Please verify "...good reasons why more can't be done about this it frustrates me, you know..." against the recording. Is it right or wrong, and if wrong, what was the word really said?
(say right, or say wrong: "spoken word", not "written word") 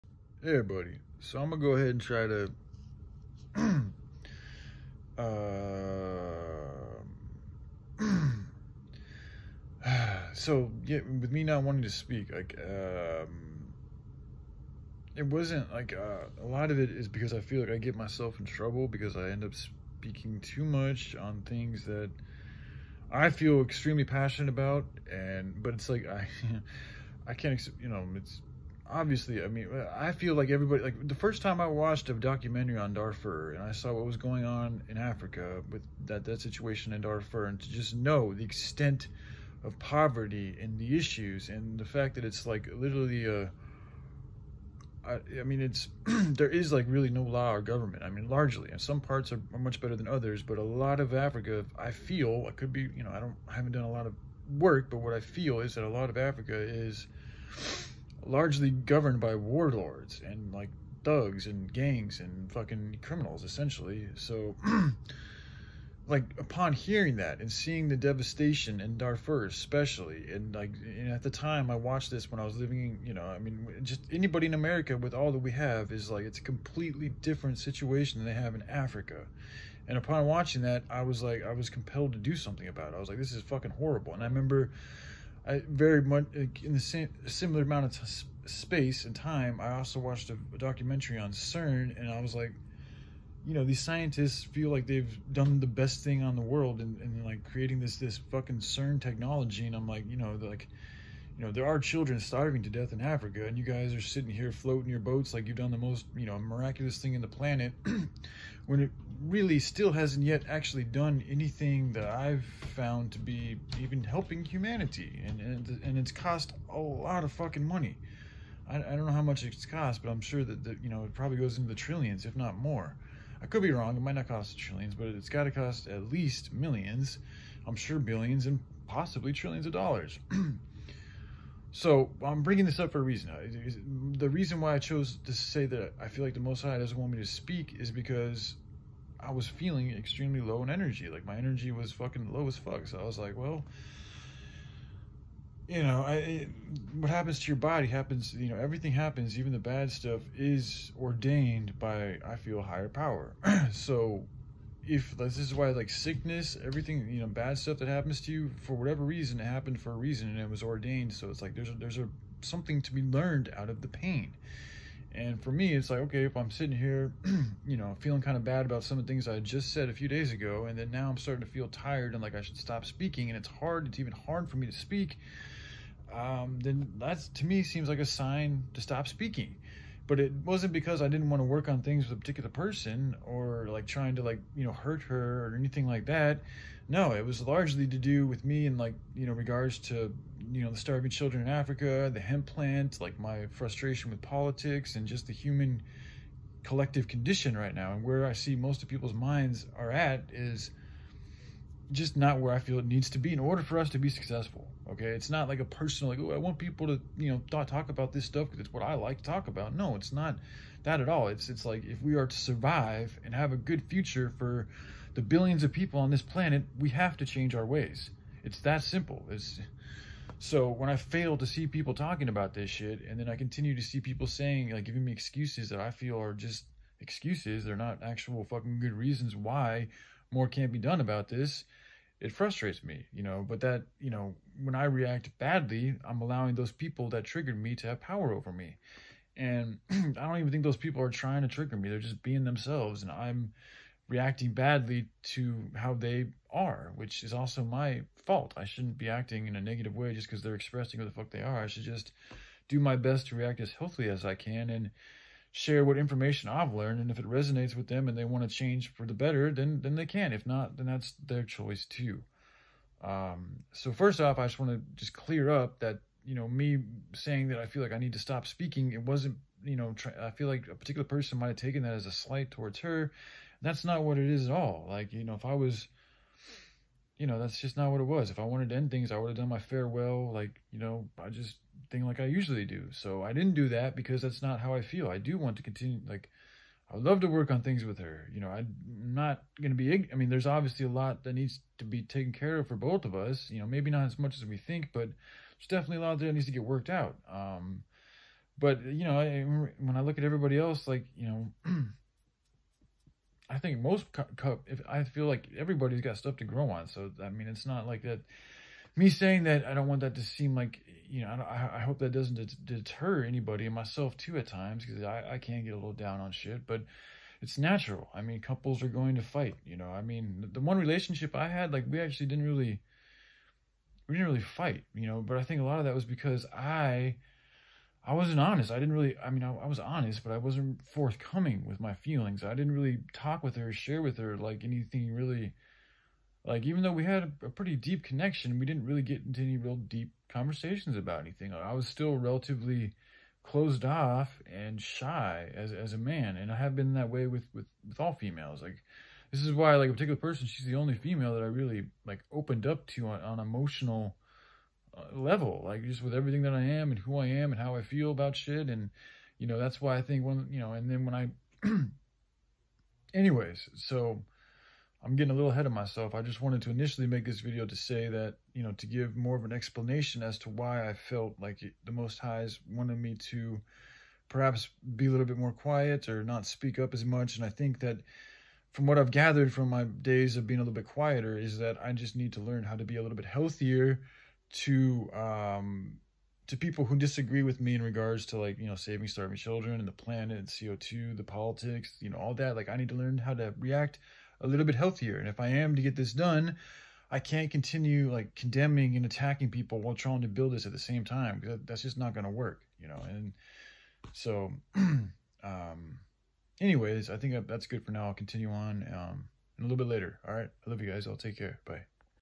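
right.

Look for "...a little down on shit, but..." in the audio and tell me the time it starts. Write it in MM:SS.
05:15.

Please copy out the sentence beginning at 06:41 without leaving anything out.
Cause that's just not going to work, you know?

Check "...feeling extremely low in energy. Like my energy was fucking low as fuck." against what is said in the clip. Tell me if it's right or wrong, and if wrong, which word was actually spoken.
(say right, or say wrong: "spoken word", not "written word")
right.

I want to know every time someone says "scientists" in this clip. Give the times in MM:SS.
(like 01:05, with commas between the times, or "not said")
01:33.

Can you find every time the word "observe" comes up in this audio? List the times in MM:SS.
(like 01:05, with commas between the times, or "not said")
not said.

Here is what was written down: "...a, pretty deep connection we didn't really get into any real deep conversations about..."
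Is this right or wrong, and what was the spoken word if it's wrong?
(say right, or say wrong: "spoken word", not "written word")
right.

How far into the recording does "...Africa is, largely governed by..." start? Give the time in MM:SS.
00:56.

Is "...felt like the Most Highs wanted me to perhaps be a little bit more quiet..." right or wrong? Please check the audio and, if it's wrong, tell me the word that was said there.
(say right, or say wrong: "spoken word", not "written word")
right.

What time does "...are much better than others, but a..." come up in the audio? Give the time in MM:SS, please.
00:49.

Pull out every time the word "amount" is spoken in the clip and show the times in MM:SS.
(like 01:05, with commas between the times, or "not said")
01:27.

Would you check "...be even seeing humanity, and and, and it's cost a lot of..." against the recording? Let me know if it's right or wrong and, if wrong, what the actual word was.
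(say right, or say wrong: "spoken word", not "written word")
wrong: "helping", not "seeing".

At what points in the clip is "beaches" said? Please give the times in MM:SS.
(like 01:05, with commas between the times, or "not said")
not said.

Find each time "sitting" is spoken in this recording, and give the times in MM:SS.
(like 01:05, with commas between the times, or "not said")
01:44, 02:46.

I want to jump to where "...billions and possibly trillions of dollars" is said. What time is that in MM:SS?
02:07.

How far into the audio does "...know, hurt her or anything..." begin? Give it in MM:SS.
03:04.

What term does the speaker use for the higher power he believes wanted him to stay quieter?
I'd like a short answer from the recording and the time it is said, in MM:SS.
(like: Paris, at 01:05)
The Most High, at 02:16.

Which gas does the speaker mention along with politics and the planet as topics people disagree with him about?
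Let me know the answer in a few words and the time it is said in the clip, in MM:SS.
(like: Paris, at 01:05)
CO2, at 06:30.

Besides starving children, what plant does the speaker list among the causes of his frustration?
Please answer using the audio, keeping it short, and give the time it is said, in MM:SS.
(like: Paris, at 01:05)
Hemp, at 03:12.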